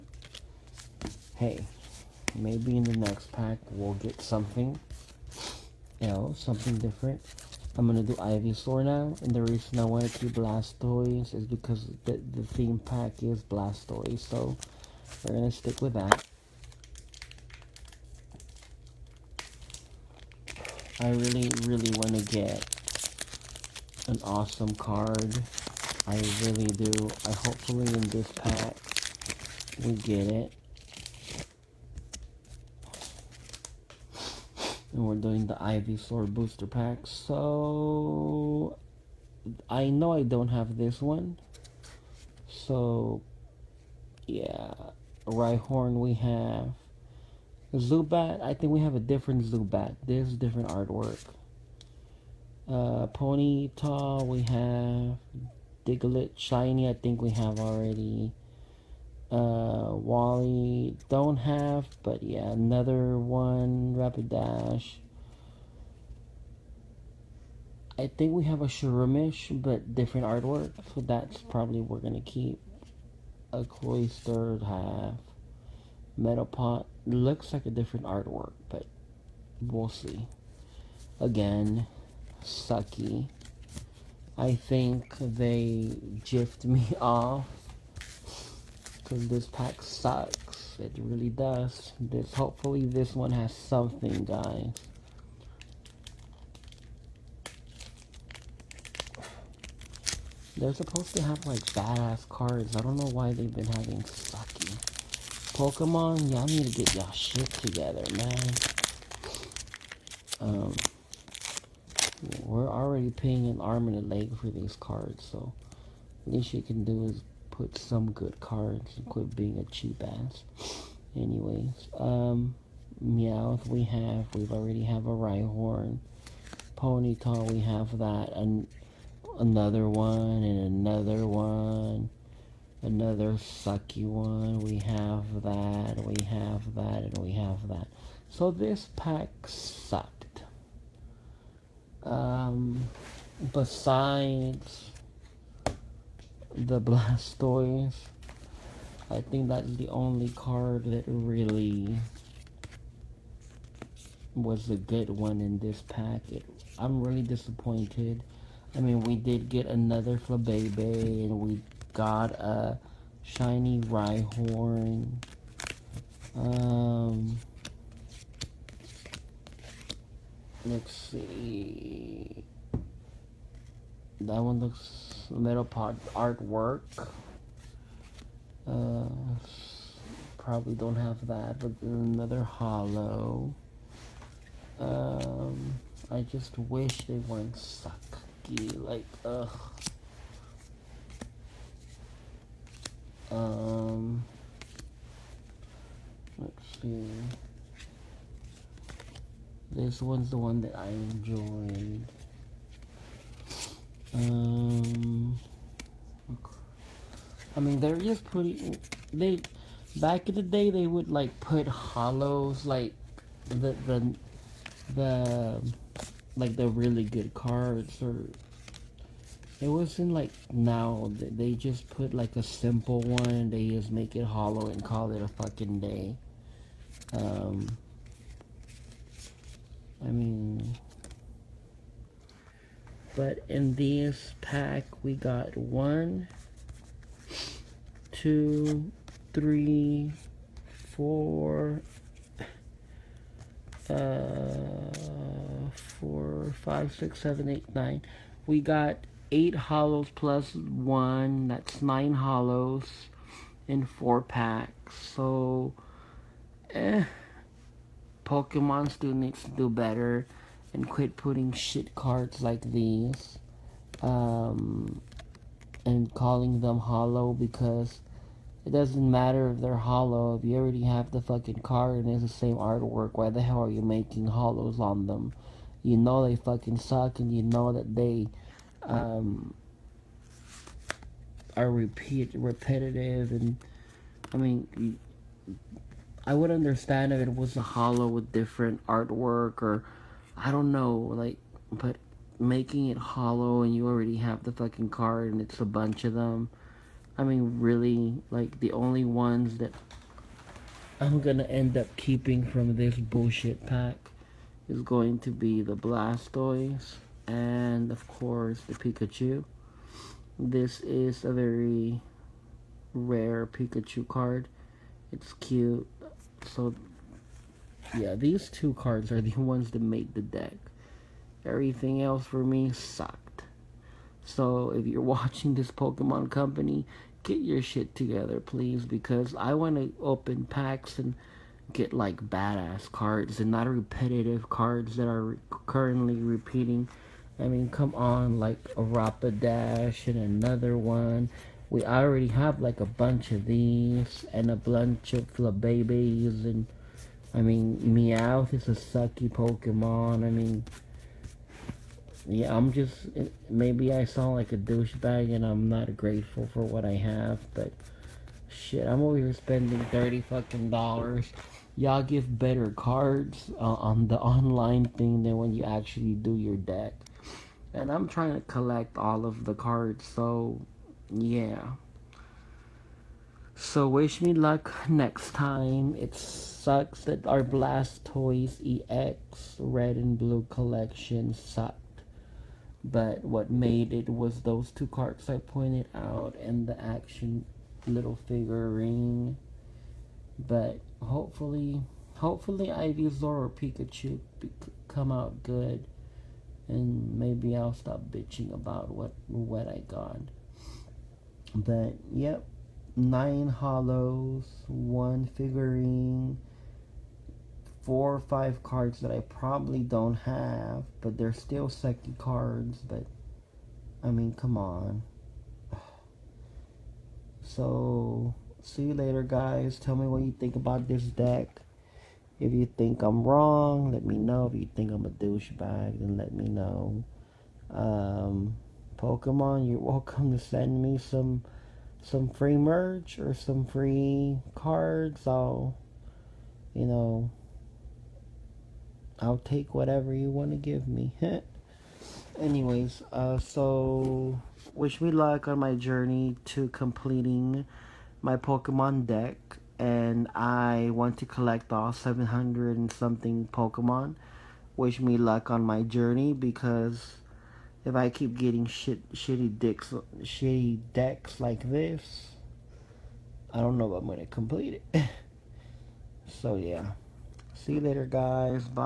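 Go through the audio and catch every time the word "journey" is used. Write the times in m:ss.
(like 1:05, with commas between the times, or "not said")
7:25, 7:35.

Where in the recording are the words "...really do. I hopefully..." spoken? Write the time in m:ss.
0:26.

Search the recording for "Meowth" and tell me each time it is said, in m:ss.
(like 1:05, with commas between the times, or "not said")
2:03, 5:47.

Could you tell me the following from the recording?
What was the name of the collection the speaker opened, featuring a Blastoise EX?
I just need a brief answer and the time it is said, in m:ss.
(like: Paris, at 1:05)
Blastoise EX Red and Blue collection, at 6:17.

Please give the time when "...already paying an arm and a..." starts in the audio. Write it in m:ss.
1:52.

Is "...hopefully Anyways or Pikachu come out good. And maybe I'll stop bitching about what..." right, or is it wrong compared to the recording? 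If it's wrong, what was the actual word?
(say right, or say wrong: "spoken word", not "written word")
wrong: "Ivysaur", not "Anyways".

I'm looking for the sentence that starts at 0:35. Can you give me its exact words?
and we're doing the Ivysaur booster pack.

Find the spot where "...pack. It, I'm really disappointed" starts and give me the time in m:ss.
2:35.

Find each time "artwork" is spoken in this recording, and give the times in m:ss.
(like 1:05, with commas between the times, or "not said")
0:50, 1:10, 1:18, 2:56, 4:32, 4:48.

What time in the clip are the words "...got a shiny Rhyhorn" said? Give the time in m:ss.
2:41.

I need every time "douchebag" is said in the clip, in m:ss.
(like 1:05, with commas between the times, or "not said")
5:54, 7:05.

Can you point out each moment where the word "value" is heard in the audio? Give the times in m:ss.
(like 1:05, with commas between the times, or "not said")
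not said.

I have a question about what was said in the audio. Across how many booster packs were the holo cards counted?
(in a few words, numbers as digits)
4.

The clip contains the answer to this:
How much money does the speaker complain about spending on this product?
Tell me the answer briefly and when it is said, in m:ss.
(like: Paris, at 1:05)
$30, at 5:59.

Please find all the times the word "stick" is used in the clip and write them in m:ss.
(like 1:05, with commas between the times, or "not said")
0:15.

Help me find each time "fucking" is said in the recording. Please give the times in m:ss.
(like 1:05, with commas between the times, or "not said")
3:45, 4:31, 4:36, 4:54, 6:00.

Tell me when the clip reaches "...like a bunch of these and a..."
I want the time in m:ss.
5:42.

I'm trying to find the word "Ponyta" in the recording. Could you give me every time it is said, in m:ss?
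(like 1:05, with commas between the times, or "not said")
0:53, 2:06.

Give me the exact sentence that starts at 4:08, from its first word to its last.
We got eight hollows plus one.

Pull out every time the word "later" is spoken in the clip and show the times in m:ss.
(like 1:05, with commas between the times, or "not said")
6:58, 7:47.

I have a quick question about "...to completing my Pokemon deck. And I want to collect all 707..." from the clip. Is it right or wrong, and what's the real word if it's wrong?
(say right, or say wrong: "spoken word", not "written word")
wrong: "700", not "707".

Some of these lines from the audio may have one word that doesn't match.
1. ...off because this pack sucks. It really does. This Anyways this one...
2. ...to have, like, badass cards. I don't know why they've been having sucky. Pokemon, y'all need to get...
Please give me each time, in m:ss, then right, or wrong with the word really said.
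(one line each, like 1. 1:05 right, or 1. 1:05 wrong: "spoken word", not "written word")
1. 1:27 wrong: "Hopefully", not "Anyways"
2. 1:41 right.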